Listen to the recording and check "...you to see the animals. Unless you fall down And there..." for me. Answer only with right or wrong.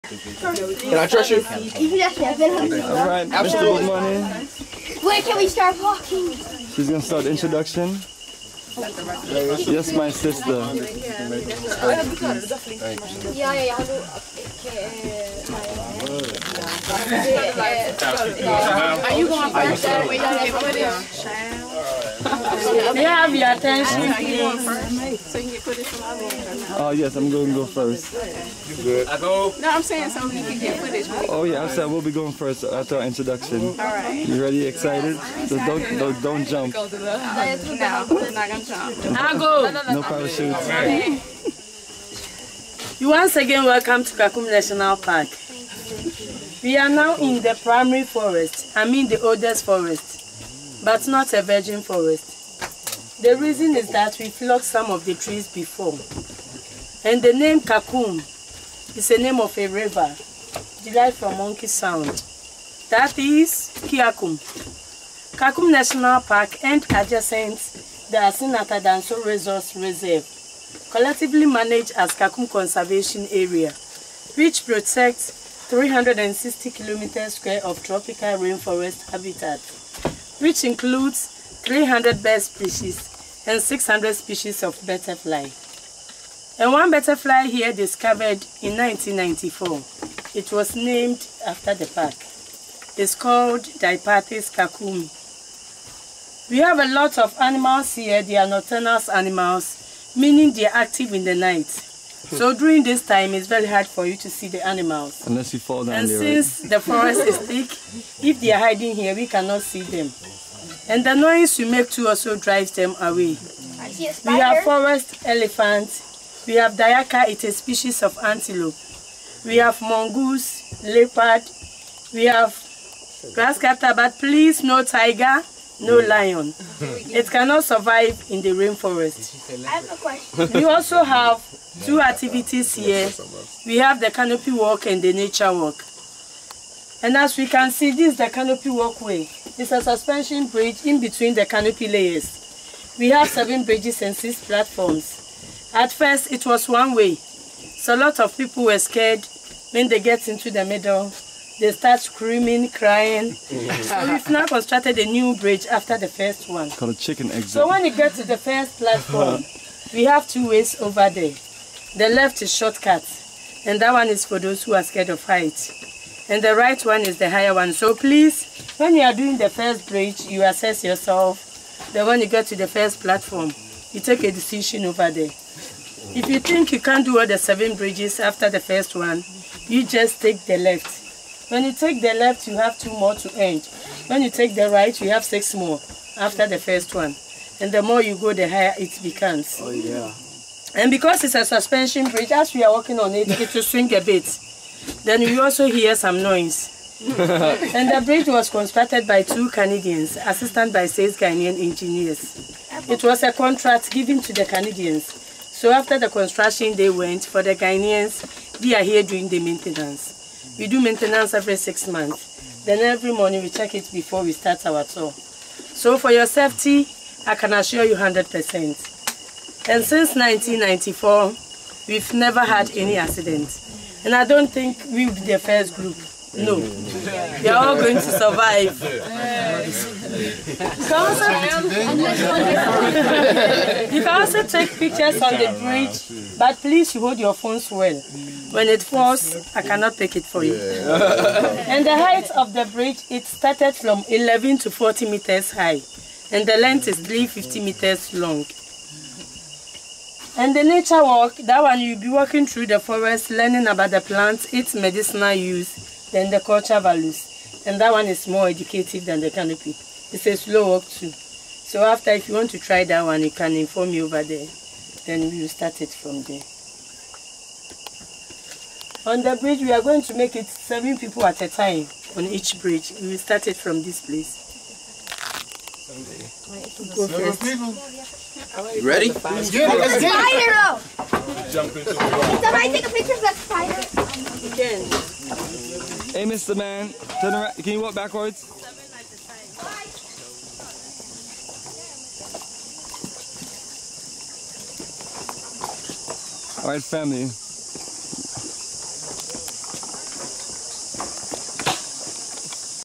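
right.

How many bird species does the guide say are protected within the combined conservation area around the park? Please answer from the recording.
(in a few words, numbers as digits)
300.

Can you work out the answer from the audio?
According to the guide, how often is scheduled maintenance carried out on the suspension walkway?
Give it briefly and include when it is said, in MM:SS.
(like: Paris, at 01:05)
every 6 months, at 03:31.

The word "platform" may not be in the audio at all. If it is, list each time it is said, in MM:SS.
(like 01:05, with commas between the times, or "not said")
02:24, 02:38, 02:53.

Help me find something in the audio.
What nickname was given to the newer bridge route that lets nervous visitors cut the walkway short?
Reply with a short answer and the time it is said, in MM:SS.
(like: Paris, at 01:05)
chicken exit, at 02:36.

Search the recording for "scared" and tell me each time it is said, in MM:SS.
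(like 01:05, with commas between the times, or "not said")
02:28, 02:44.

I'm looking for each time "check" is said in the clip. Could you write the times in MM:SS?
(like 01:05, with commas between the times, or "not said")
03:33.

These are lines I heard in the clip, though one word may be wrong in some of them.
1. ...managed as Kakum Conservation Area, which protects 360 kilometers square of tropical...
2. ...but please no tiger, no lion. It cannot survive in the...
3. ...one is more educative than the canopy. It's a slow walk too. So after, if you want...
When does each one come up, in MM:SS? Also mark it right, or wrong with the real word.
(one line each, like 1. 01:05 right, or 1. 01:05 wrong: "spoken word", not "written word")
1. 01:11 right
2. 02:03 right
3. 04:17 right.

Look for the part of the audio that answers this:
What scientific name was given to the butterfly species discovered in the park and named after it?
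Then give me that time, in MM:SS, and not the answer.
01:33.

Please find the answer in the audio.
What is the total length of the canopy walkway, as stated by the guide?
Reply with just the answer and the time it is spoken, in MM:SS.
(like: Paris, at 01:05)
350 meters, at 04:06.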